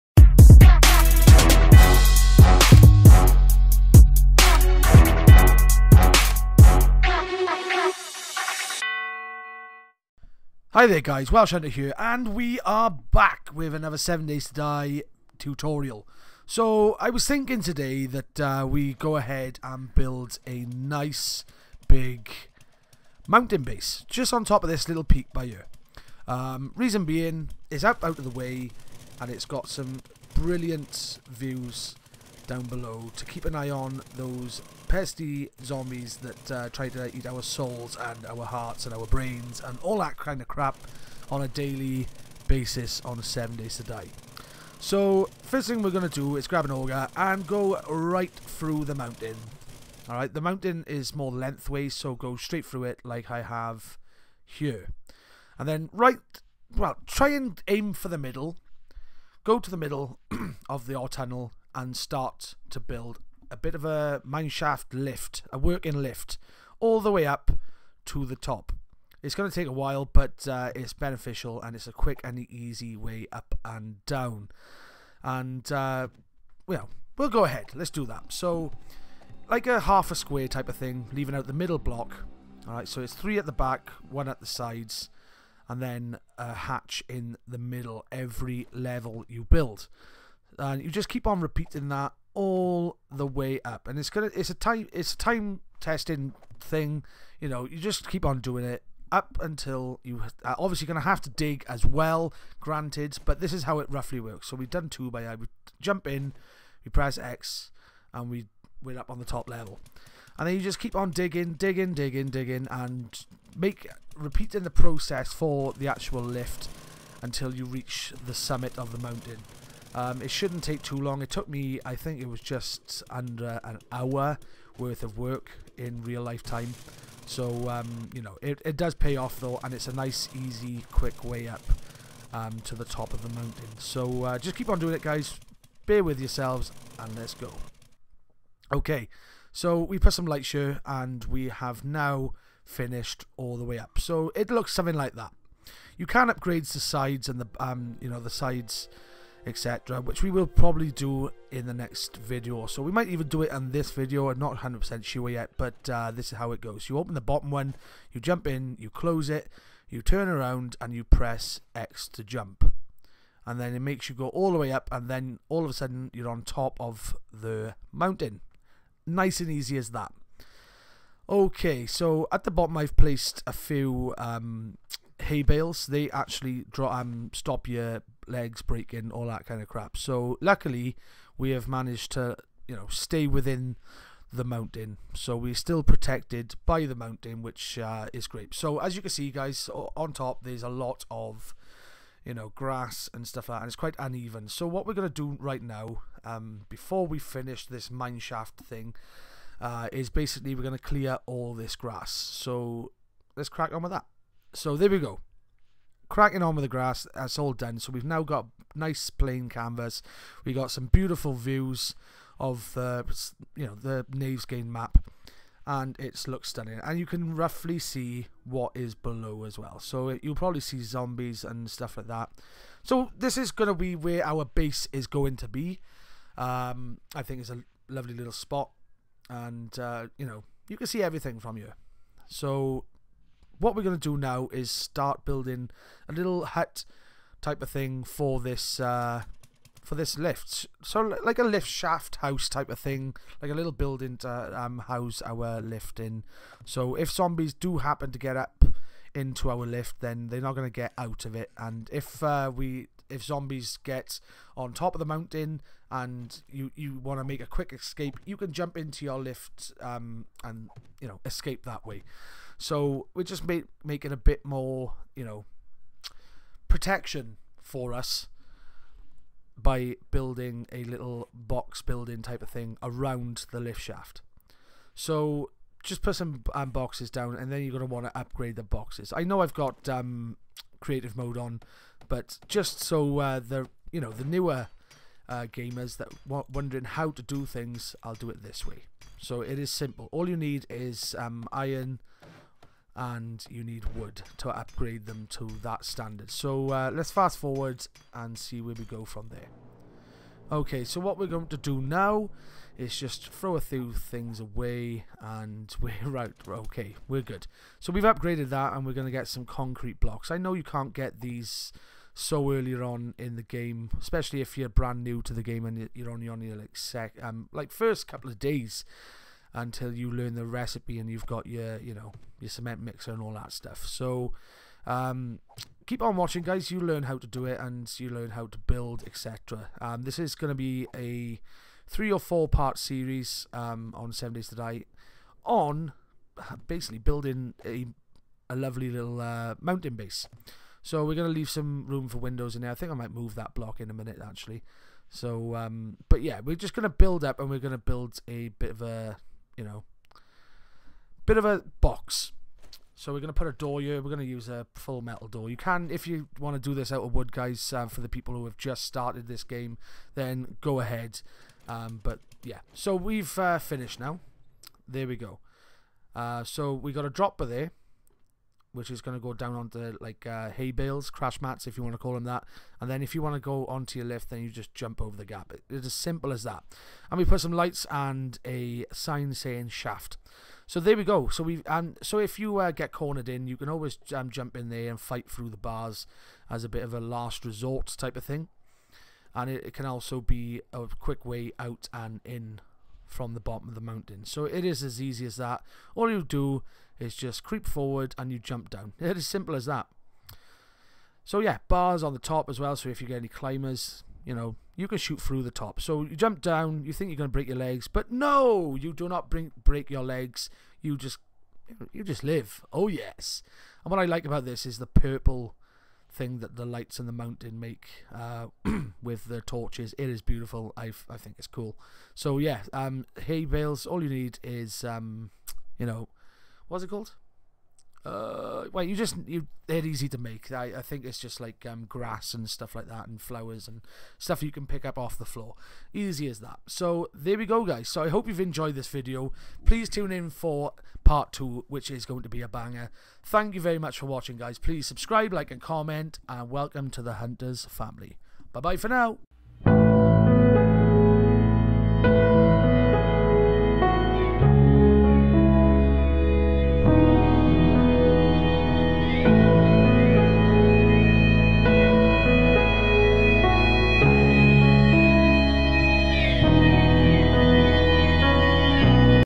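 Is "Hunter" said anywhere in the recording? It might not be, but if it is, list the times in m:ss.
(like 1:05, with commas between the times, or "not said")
0:11, 7:27.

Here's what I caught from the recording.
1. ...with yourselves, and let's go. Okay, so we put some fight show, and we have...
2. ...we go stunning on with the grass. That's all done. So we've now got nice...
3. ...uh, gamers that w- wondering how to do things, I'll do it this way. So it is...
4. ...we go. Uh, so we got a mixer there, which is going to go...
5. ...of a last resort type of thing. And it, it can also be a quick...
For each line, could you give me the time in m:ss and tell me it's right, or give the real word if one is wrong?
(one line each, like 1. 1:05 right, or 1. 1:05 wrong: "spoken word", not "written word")
1. 2:16 wrong: "light", not "fight"
2. 3:24 wrong: "cracking", not "stunning"
3. 4:45 right
4. 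6:05 wrong: "dropper", not "mixer"
5. 6:26 right.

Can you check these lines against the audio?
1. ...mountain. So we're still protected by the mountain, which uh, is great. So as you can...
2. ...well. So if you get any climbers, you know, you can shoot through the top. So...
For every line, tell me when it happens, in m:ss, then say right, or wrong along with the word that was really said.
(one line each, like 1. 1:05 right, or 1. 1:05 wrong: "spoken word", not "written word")
1. 3:04 right
2. 6:42 right.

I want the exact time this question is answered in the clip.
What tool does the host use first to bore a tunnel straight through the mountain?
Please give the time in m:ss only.
0:46.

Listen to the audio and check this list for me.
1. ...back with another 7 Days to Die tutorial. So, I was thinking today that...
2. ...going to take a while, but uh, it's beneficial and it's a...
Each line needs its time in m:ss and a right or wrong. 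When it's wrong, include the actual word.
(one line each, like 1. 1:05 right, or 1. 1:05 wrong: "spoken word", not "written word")
1. 0:12 right
2. 1:09 right.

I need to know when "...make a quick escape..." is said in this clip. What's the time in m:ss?
4:17.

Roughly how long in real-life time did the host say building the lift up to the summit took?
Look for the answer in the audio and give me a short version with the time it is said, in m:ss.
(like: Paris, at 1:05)
just under an hour, at 2:02.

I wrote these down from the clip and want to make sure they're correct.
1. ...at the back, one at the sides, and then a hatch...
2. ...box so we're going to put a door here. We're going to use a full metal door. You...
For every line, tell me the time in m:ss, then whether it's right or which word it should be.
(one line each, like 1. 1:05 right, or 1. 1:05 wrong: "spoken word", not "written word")
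1. 1:23 right
2. 5:51 right.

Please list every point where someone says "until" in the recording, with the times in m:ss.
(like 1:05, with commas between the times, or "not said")
1:39, 1:57, 5:19.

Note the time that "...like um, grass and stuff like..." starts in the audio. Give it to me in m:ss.
7:11.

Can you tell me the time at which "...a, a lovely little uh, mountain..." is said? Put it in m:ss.
5:37.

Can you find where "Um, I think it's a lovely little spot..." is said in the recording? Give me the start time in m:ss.
3:46.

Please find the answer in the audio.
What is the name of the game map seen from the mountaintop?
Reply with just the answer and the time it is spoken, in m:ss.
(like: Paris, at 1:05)
Navezgane, at 3:34.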